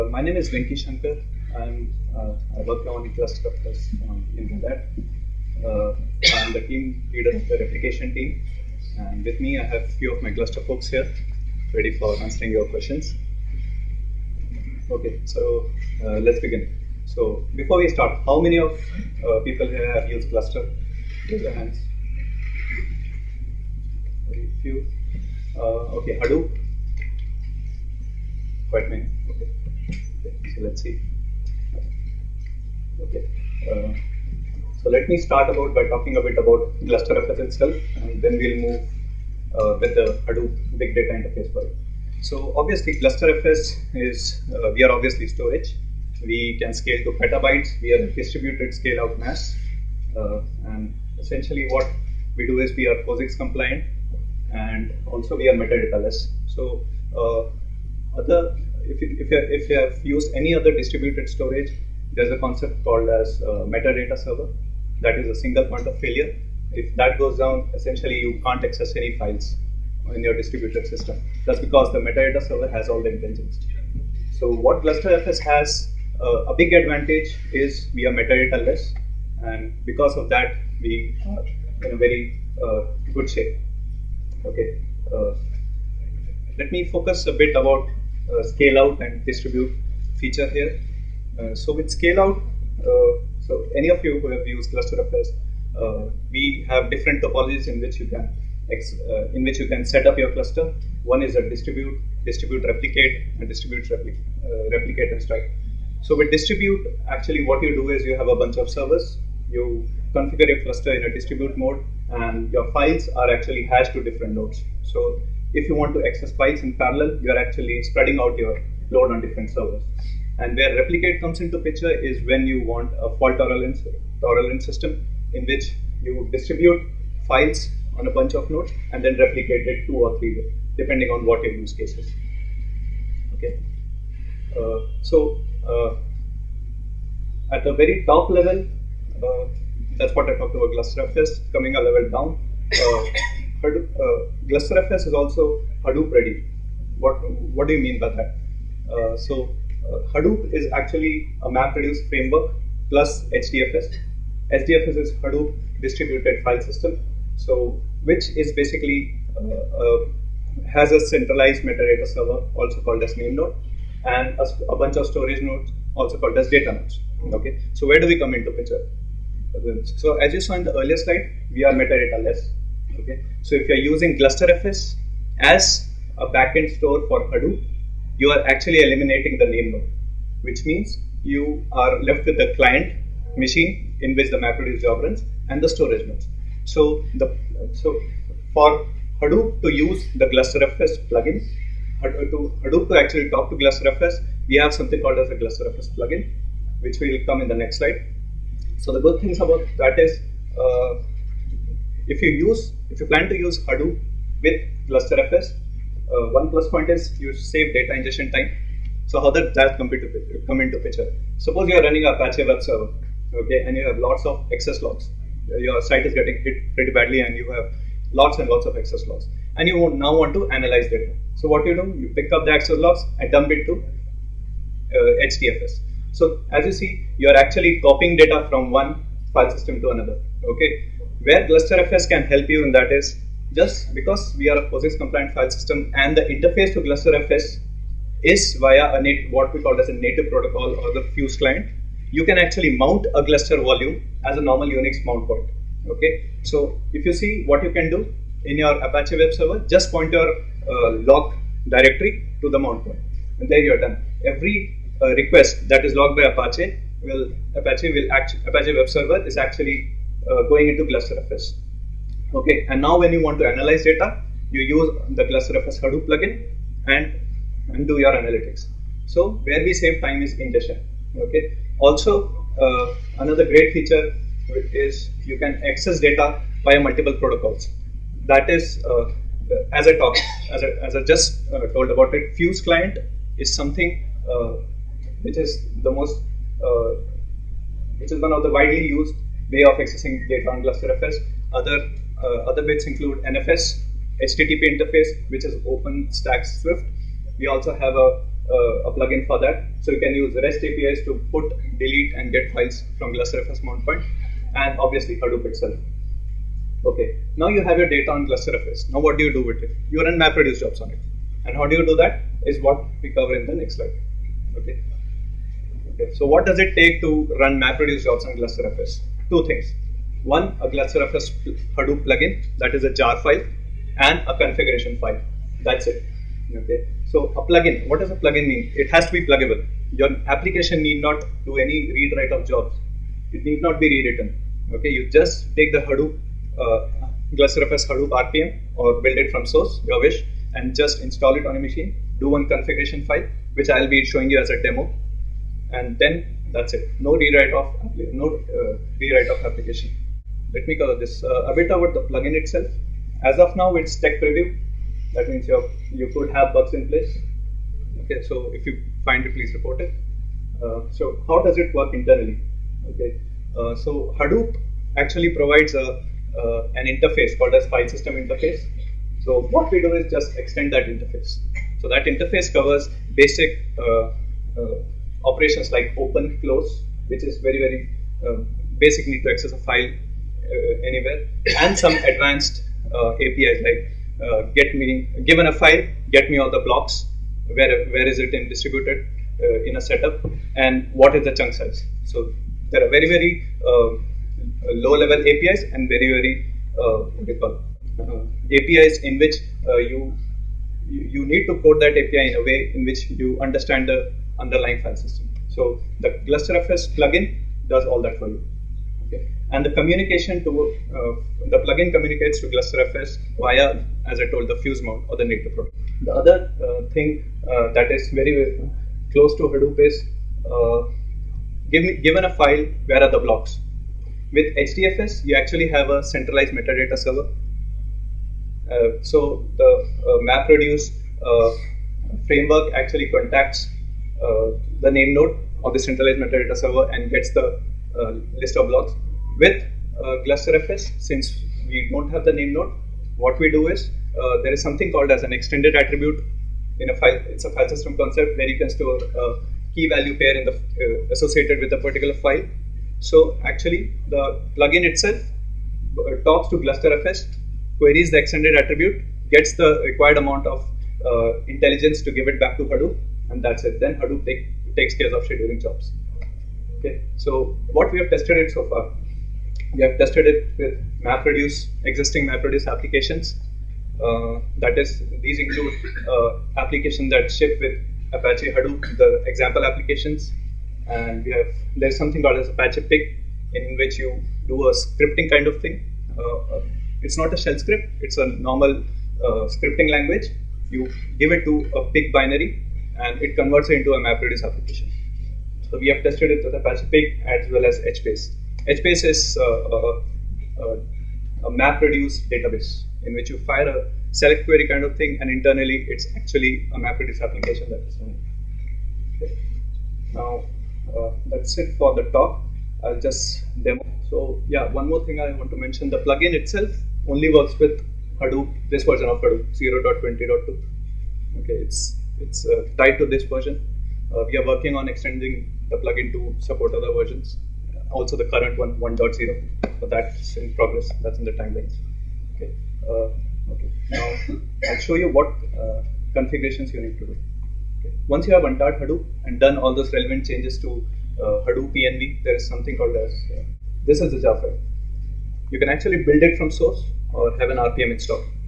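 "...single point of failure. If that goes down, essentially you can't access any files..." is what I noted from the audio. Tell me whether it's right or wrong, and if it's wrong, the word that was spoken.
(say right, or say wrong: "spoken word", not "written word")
right.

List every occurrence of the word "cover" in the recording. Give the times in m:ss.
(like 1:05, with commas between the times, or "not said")
5:13, 5:50, 6:12.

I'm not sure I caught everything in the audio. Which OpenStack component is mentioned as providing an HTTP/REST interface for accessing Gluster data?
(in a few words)
OpenStack Swift.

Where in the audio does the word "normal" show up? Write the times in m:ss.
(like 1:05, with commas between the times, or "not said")
4:04, 8:08.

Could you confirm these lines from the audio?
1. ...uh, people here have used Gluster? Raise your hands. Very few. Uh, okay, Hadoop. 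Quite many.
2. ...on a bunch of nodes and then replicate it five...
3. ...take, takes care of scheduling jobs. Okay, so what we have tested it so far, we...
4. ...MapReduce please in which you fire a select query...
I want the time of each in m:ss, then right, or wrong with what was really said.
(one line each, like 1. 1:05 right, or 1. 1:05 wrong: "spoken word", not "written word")
1. 0:18 right
2. 2:07 wrong: "two", not "five"
3. 7:44 right
4. 8:21 wrong: "database", not "please".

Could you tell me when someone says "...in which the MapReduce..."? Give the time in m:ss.
3:04.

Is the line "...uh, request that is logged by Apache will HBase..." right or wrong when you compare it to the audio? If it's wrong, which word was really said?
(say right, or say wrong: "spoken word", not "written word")
wrong: "Apache", not "HBase".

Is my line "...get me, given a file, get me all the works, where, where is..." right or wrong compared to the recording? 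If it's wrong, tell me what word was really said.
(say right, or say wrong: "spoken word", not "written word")
wrong: "blocks", not "works".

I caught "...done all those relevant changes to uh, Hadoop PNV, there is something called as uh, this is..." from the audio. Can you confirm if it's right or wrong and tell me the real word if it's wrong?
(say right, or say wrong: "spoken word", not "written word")
right.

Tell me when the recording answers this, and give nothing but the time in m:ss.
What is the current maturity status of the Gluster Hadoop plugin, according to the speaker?
5:53.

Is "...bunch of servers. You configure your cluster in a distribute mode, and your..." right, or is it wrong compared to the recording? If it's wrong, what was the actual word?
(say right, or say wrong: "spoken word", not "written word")
right.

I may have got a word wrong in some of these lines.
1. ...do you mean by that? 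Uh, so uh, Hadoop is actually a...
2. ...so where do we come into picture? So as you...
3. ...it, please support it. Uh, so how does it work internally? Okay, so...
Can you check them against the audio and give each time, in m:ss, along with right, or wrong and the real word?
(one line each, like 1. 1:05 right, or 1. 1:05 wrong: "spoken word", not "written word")
1. 2:27 right
2. 2:47 right
3. 5:59 wrong: "report", not "support".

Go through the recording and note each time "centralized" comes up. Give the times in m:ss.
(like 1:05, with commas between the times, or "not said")
2:41, 7:06, 7:15.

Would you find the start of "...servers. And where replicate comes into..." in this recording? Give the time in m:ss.
1:59.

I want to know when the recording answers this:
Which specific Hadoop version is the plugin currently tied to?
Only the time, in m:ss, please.
8:39.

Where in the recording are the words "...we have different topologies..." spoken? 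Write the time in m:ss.
1:36.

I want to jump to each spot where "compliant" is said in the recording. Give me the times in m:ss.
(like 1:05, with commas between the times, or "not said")
0:53, 3:54.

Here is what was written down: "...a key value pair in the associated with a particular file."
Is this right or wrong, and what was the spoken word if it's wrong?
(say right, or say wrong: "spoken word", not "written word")
right.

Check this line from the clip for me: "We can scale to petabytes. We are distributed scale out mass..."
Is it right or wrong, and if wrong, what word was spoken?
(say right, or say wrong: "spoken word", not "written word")
right.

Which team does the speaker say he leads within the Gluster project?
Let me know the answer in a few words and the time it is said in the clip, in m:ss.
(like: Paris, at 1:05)
Replication team, at 0:07.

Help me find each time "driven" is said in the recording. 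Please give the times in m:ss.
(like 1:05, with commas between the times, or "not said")
not said.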